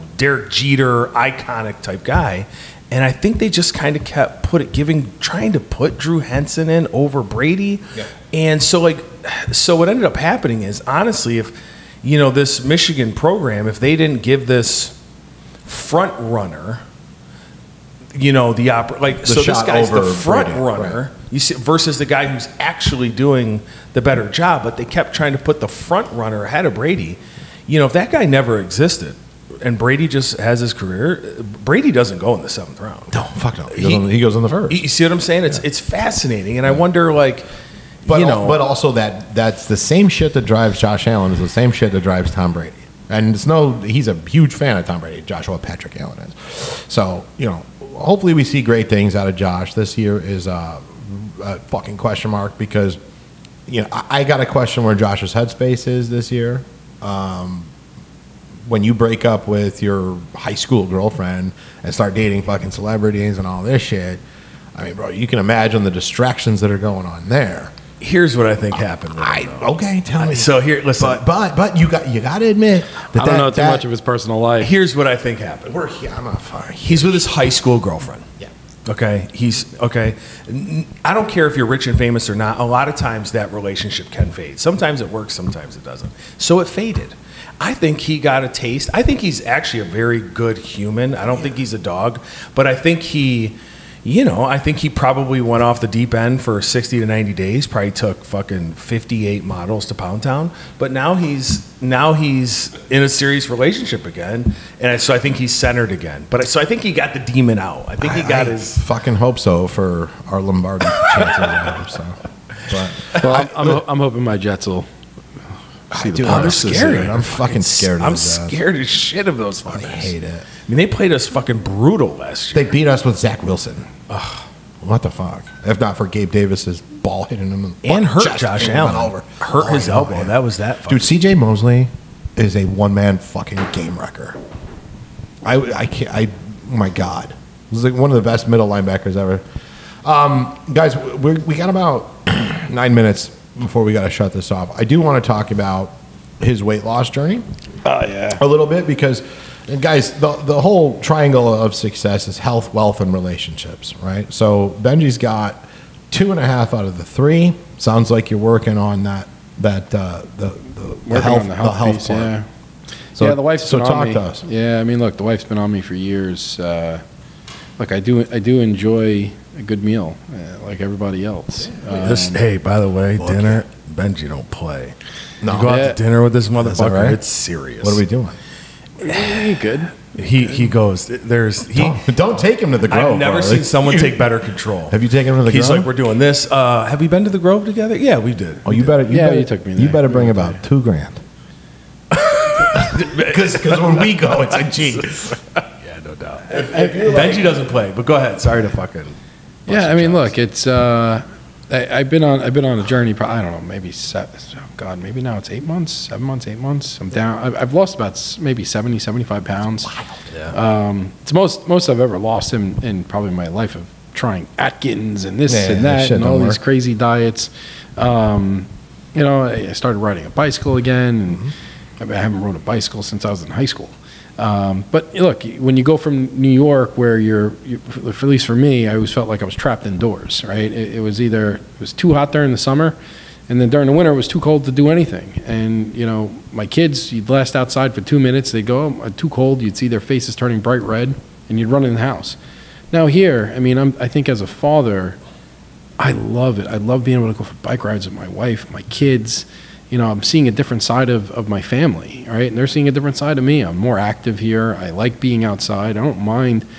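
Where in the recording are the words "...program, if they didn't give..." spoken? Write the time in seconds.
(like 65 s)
13 s.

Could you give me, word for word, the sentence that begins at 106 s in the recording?
But so I think he got the demon out.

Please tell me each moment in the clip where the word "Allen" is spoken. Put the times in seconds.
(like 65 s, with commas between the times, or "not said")
41 s, 46 s, 128 s.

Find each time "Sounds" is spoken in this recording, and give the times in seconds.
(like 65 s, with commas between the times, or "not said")
157 s.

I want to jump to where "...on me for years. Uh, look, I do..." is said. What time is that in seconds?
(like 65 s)
165 s.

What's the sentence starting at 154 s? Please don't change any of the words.
So Benji's got two and a half out of the three.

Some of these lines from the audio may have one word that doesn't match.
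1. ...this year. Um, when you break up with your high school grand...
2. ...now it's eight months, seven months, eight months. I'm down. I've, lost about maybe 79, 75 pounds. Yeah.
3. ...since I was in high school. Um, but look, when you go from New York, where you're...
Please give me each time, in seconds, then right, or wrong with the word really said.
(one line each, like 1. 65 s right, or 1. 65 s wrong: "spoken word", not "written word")
1. 56 s wrong: "girlfriend", not "grand"
2. 205 s wrong: "70", not "79"
3. 223 s right.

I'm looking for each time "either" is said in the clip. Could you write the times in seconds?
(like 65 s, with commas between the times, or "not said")
231 s.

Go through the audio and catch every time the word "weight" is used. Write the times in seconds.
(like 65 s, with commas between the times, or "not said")
146 s.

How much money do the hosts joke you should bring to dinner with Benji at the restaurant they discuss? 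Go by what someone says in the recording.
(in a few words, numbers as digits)
2 grand.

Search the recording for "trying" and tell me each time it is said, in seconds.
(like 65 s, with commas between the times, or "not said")
5 s, 25 s, 214 s.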